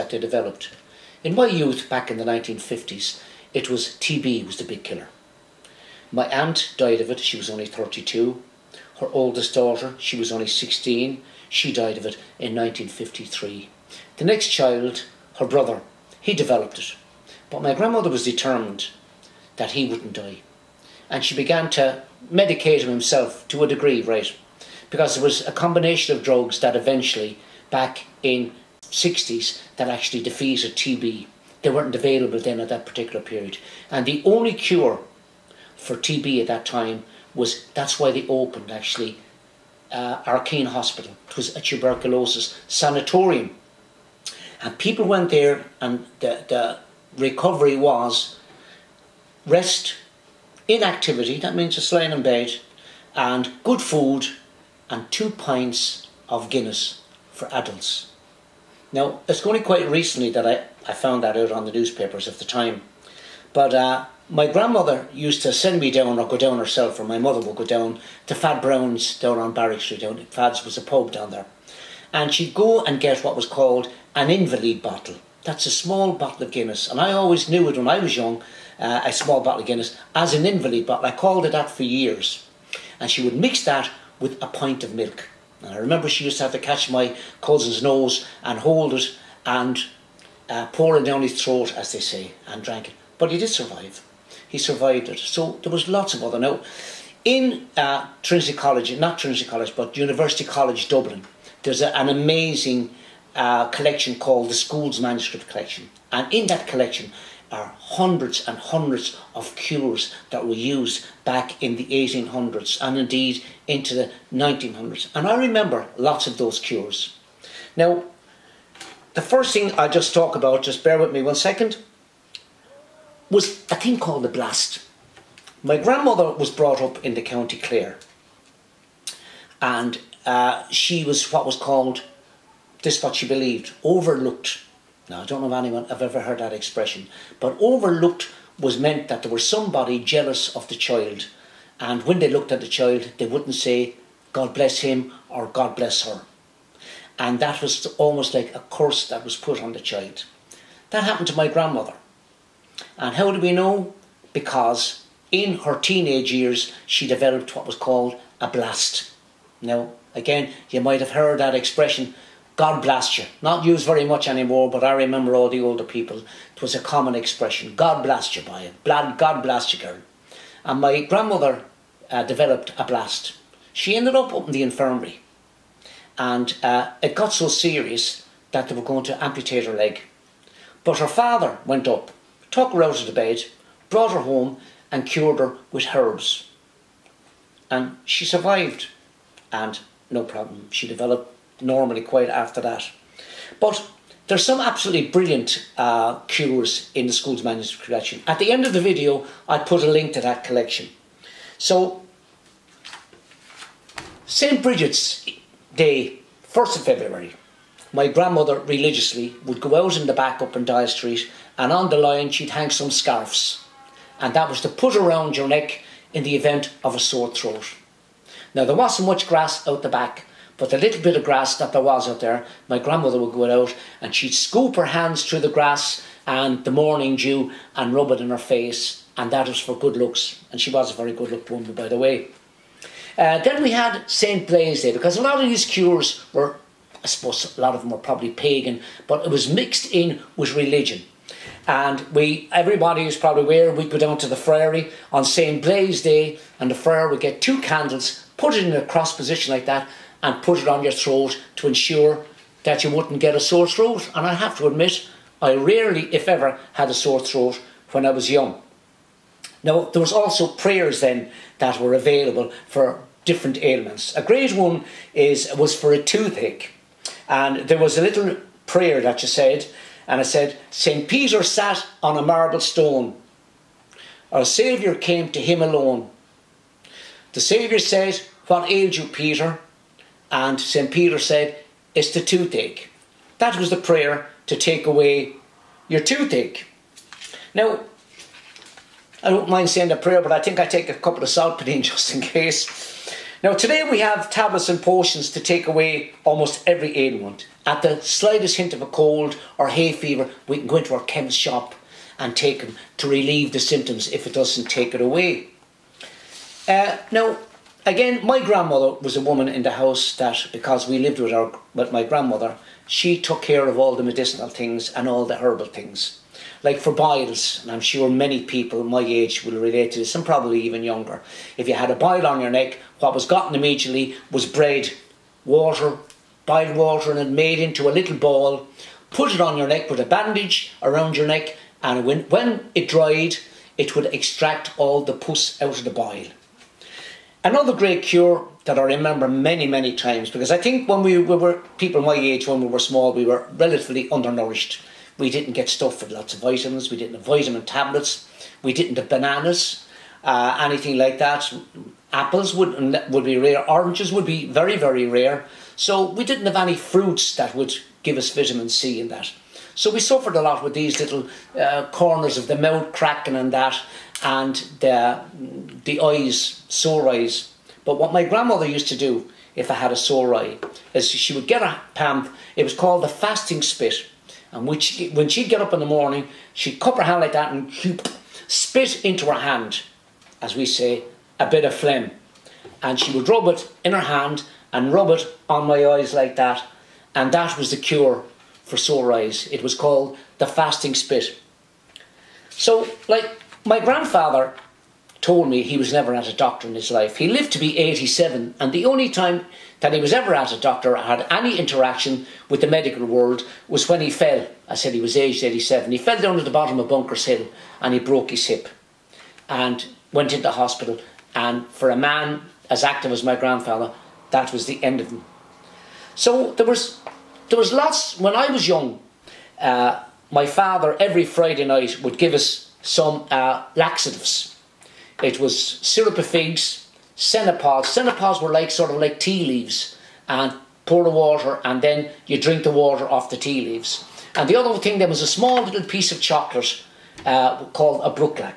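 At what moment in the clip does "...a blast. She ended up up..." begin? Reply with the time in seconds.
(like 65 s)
172 s.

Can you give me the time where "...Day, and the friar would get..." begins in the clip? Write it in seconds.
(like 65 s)
246 s.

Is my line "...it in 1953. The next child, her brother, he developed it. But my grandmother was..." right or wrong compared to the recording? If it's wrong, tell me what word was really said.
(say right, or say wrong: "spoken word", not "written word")
right.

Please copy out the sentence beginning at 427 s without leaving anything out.
Cenopods were like sort of like tea leaves and pour the water and then you drink the water off the tea leaves.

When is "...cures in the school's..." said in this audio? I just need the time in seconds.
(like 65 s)
196 s.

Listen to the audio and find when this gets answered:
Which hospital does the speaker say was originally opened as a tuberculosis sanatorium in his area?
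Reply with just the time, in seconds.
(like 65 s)
40 s.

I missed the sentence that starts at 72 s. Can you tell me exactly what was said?
And she'd go and get what was called an invalid bottle.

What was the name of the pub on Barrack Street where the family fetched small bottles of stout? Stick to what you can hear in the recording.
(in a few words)
Fad Brown's.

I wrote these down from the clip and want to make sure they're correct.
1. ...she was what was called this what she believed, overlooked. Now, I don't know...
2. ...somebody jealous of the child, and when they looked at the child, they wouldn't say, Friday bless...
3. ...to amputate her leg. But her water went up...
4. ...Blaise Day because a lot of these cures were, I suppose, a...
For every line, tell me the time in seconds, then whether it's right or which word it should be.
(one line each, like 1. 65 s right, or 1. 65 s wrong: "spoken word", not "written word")
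1. 130 s right
2. 139 s wrong: "God", not "Friday"
3. 179 s wrong: "father", not "water"
4. 234 s right.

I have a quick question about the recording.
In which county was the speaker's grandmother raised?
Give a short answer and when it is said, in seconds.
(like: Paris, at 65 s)
County Clare, at 127 s.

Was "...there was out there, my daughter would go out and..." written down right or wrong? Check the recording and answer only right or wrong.
wrong.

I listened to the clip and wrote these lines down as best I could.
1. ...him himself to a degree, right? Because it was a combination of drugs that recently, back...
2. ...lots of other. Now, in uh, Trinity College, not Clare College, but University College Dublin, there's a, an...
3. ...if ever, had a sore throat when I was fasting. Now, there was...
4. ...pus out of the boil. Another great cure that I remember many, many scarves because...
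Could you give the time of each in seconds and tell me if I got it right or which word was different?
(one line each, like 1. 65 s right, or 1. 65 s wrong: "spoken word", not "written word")
1. 22 s wrong: "eventually", not "recently"
2. 95 s wrong: "Trinity", not "Clare"
3. 256 s wrong: "young", not "fasting"
4. 335 s wrong: "times", not "scarves".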